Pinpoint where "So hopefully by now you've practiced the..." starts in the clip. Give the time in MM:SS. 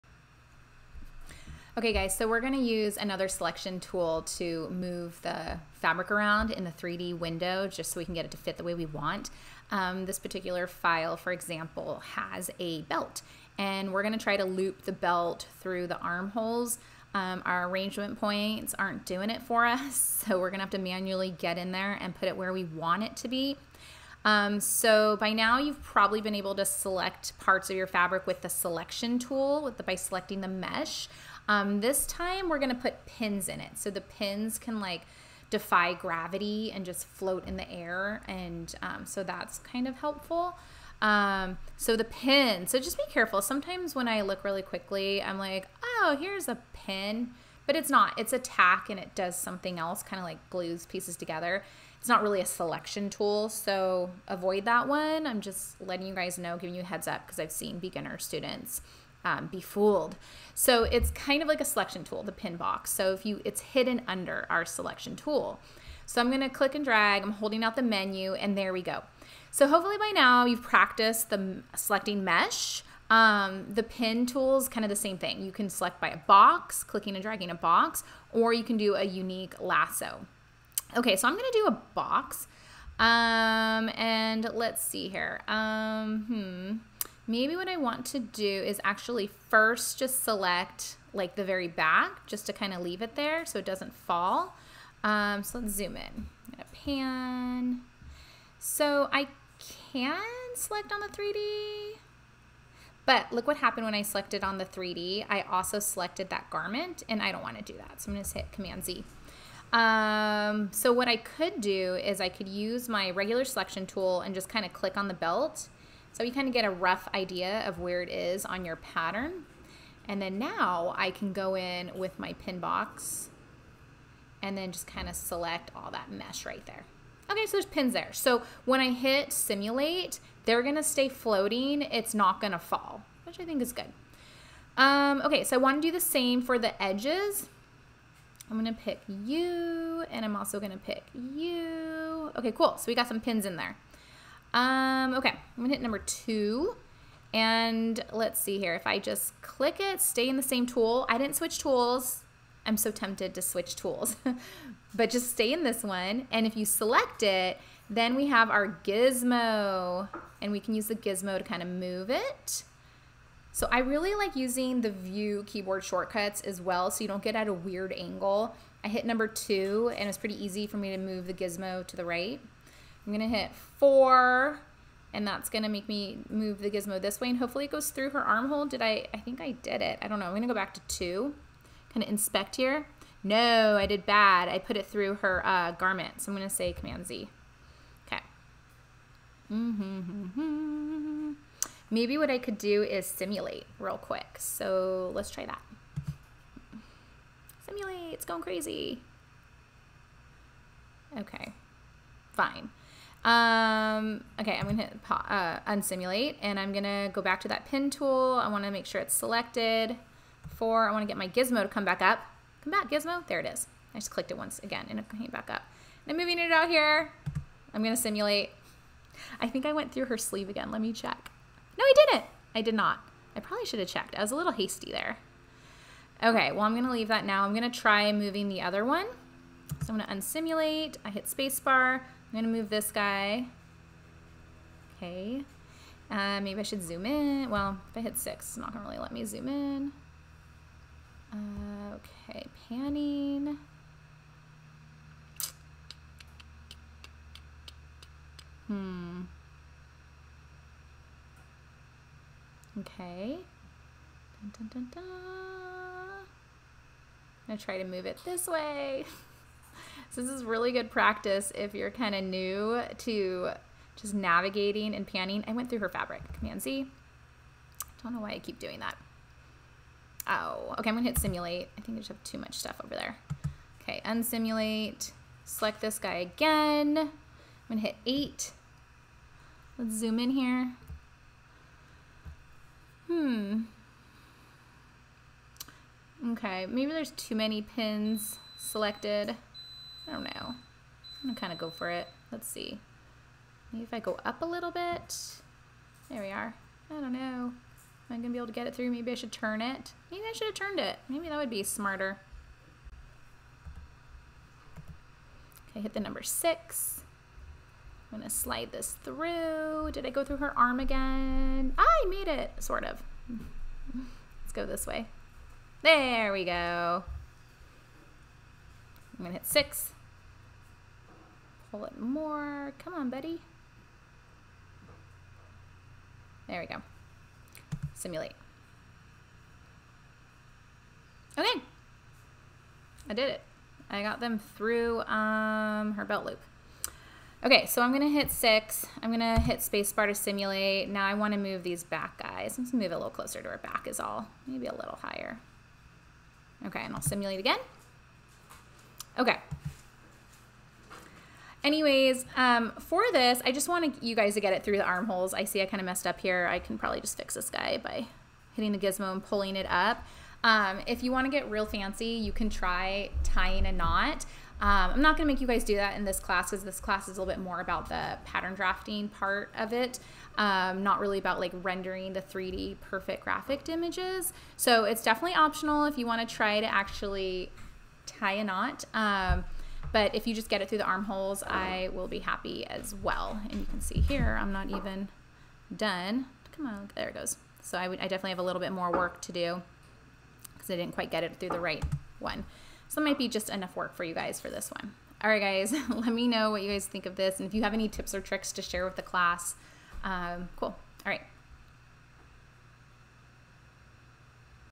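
01:09.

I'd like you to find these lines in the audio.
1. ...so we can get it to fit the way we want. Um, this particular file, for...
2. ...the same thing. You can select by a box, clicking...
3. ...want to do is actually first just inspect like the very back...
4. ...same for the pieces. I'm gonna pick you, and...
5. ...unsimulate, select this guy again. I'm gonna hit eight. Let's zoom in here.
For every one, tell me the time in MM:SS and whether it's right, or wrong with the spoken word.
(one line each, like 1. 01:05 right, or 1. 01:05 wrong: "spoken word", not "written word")
1. 00:07 right
2. 01:14 right
3. 01:27 wrong: "select", not "inspect"
4. 02:15 wrong: "edges", not "pieces"
5. 04:34 right.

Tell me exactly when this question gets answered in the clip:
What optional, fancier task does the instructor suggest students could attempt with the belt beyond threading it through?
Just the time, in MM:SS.
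06:03.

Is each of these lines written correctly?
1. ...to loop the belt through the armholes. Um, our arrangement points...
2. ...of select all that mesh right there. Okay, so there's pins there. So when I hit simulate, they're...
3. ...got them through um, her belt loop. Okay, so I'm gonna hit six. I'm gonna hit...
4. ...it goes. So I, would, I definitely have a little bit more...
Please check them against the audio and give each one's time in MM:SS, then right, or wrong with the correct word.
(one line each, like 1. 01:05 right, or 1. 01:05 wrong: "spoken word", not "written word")
1. 00:14 right
2. 02:05 right
3. 05:34 right
4. 06:27 right.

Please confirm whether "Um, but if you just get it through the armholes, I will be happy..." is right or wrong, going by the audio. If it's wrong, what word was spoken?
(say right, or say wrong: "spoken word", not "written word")
right.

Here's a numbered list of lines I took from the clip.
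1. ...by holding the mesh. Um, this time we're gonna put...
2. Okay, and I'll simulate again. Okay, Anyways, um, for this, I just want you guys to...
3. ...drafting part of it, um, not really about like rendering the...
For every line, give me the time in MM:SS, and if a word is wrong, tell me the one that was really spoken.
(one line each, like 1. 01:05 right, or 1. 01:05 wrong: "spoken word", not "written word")
1. 00:29 wrong: "selecting", not "holding"
2. 05:46 right
3. 06:08 right.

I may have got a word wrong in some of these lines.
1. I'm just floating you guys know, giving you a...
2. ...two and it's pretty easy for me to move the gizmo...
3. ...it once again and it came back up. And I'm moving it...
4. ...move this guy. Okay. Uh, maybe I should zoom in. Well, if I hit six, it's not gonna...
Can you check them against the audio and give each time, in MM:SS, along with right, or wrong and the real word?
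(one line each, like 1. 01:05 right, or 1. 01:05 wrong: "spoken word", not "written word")
1. 00:55 wrong: "letting", not "floating"
2. 02:49 right
3. 03:34 right
4. 03:52 right.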